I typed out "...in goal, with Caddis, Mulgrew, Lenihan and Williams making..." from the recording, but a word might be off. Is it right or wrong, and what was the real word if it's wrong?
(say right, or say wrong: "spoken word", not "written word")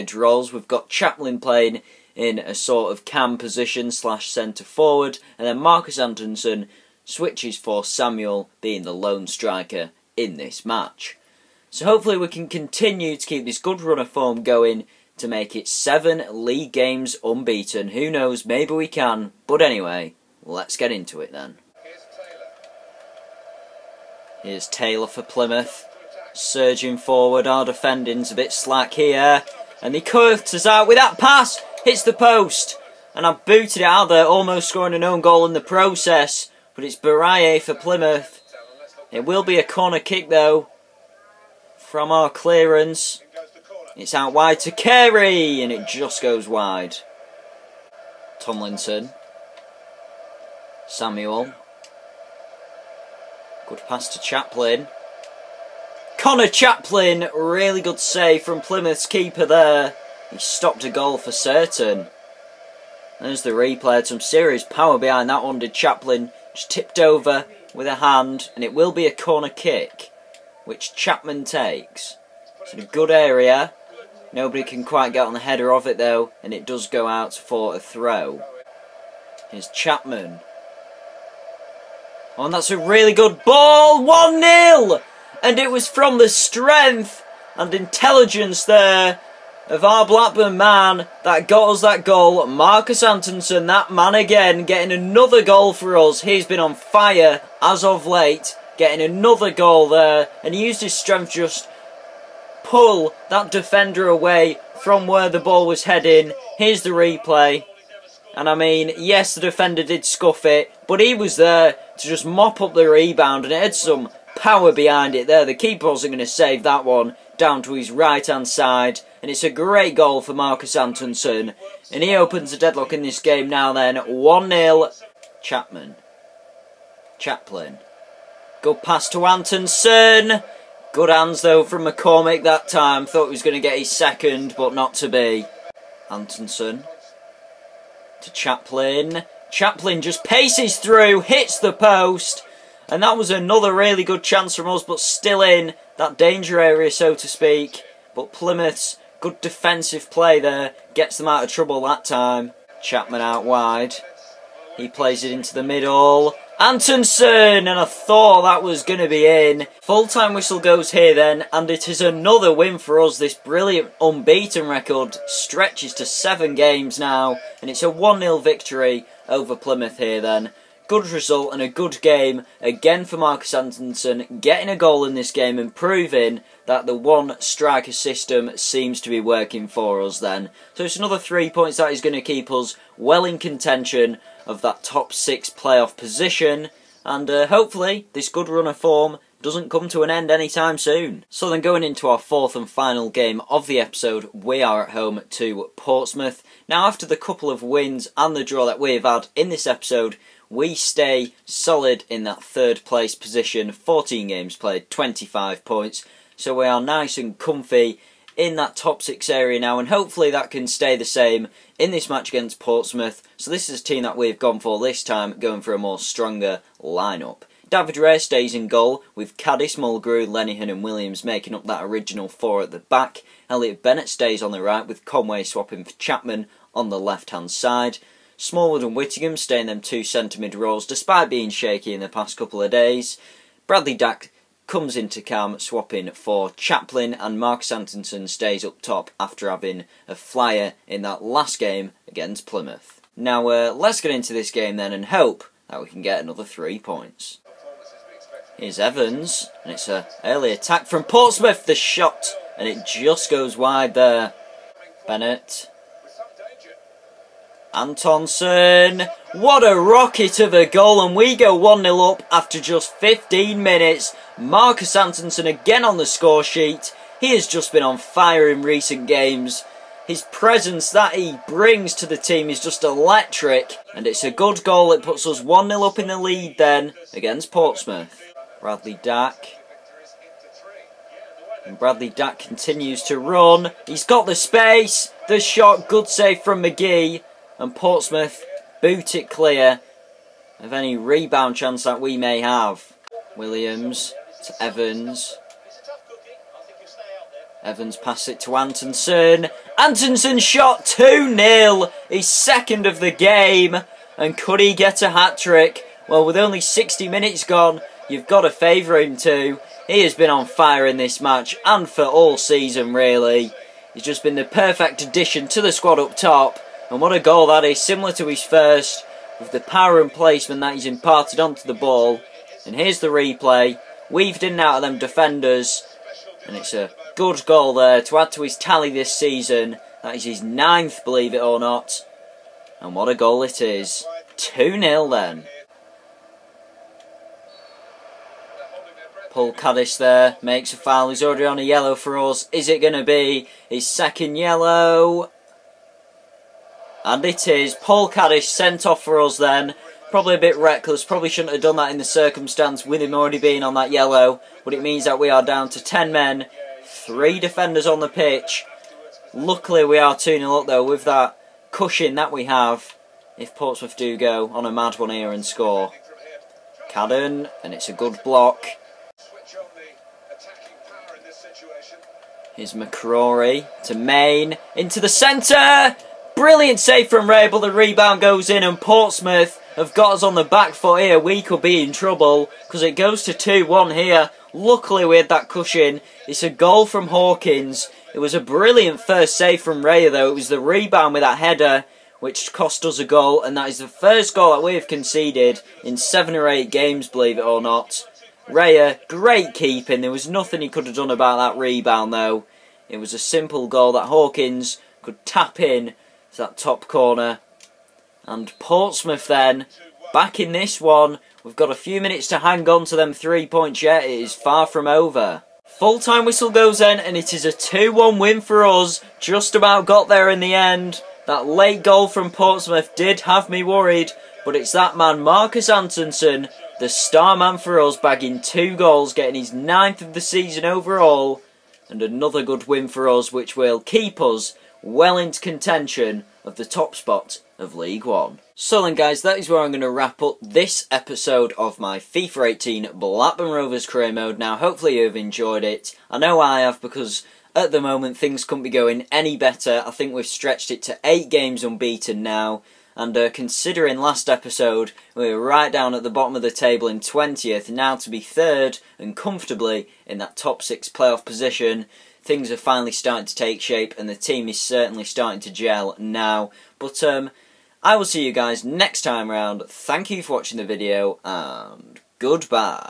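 right.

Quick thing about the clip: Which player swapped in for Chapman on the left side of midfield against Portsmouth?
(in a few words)
Conway.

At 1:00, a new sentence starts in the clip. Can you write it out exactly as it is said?
He stopped a goal for certain.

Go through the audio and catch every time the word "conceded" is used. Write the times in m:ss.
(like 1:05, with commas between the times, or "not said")
6:34.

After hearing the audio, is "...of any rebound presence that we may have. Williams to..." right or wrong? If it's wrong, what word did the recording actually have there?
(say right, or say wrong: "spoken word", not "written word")
wrong: "chance", not "presence".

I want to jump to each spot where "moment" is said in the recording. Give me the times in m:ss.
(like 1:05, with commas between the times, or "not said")
7:27.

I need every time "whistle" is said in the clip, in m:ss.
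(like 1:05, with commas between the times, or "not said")
2:40, 6:56.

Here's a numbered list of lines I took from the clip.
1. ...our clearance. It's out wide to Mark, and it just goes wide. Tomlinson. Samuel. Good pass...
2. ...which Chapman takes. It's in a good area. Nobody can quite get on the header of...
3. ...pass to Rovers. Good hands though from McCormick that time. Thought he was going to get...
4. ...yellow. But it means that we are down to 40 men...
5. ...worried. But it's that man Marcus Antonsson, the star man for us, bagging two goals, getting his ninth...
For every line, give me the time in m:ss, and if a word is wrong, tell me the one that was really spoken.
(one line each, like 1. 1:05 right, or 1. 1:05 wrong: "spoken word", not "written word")
1. 0:42 wrong: "Carey", not "Mark"
2. 1:10 right
3. 2:08 wrong: "Antonsson", not "Rovers"
4. 5:53 wrong: "10", not "40"
5. 7:03 right.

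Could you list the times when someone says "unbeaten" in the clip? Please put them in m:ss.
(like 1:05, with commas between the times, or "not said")
0:17, 2:44, 7:31.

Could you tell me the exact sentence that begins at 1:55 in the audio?
The keeper wasn't going to save that one down to his right-hand side, and it's a great goal for Marcus Antonsson.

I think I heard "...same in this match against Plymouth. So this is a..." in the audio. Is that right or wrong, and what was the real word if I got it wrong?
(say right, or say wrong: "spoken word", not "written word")
wrong: "Portsmouth", not "Plymouth".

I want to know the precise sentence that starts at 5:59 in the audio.
Luckily we are 2-0 up though with that cushion that we have.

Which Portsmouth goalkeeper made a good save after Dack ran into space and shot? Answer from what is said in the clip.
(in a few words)
McGee.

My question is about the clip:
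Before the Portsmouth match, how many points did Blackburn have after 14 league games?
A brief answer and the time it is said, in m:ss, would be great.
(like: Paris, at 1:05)
25, at 3:24.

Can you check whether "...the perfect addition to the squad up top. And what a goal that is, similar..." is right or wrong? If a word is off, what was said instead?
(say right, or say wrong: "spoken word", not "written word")
right.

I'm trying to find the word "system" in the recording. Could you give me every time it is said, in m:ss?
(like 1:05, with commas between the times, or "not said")
2:57.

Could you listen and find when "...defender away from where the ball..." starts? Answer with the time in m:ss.
1:43.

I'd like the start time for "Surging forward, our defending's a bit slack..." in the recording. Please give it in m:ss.
0:26.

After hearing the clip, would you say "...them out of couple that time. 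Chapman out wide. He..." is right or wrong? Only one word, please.
wrong.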